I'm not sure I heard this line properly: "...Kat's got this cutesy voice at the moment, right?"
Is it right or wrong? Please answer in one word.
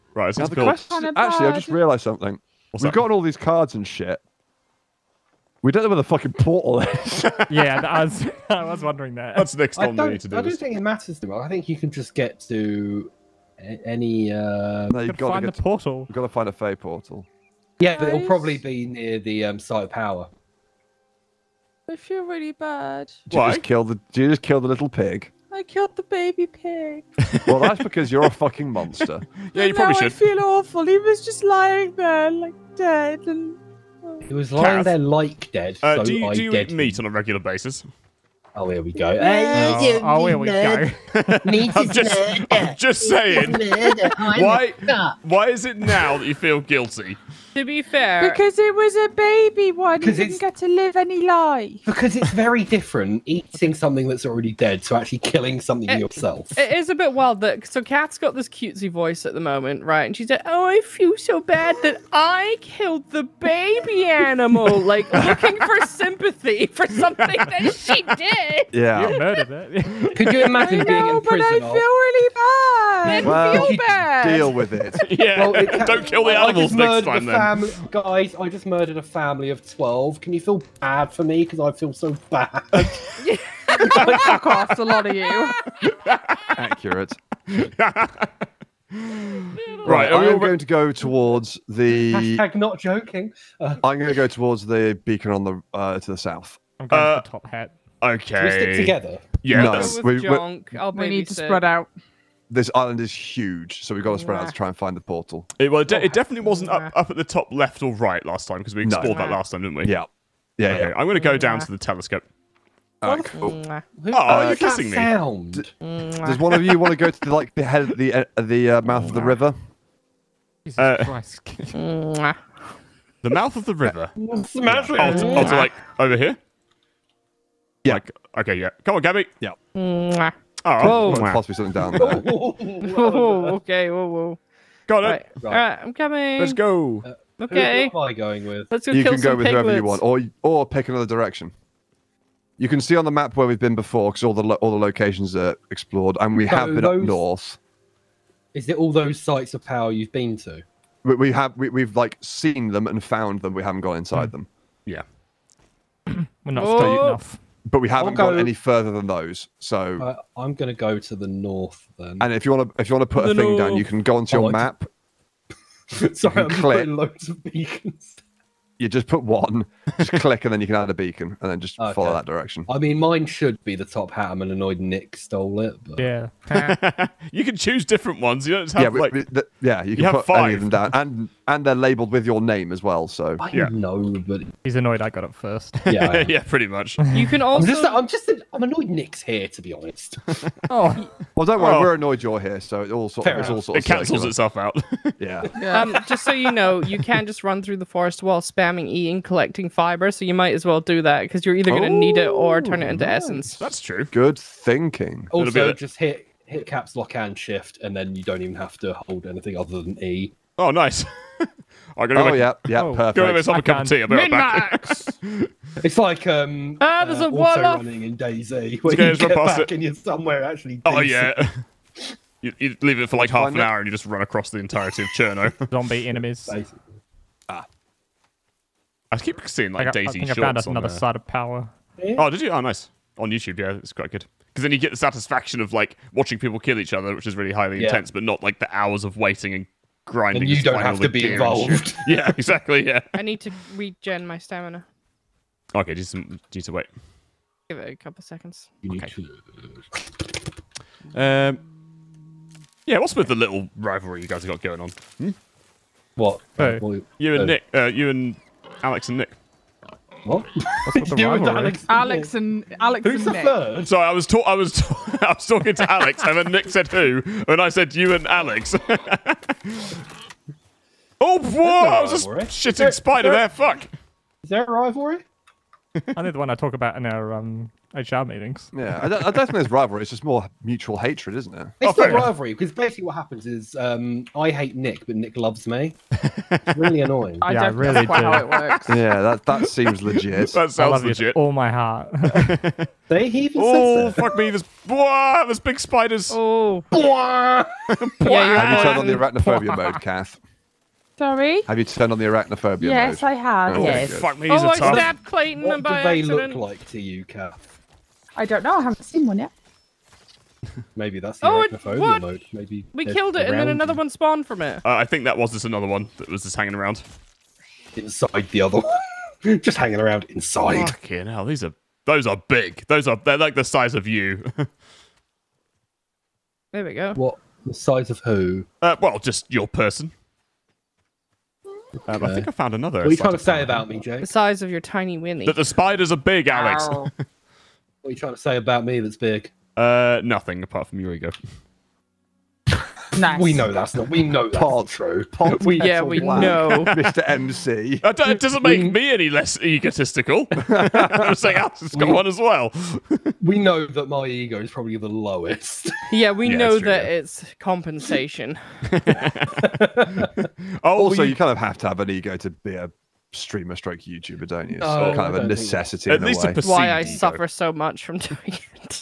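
right.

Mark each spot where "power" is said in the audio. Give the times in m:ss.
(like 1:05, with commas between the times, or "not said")
0:19, 2:29, 3:51.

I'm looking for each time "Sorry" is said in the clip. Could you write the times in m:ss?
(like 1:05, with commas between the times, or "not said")
2:46, 4:23, 5:01.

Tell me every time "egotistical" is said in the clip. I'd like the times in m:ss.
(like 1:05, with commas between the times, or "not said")
5:49.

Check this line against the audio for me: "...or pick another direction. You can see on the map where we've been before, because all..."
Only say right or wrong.
right.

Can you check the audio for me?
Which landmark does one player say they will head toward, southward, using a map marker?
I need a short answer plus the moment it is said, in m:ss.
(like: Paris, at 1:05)
the telescope, at 1:51.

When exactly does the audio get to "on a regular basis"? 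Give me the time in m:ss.
0:37.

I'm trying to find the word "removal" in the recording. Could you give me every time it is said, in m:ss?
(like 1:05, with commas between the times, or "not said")
not said.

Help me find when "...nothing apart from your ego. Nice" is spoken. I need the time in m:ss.
5:40.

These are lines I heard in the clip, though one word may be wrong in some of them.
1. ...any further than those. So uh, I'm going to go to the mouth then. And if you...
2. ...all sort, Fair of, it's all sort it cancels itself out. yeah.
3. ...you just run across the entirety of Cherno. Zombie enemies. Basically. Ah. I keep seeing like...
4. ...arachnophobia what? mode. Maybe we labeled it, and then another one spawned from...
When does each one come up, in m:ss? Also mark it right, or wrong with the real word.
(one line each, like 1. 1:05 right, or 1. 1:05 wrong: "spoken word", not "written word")
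1. 2:38 wrong: "north", not "mouth"
2. 3:12 right
3. 3:43 right
4. 5:11 wrong: "killed", not "labeled".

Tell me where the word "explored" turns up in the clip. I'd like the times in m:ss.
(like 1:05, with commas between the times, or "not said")
1:48, 2:25.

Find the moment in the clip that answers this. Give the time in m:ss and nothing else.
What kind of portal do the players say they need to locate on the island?
0:16.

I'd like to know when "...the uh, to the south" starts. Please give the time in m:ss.
1:35.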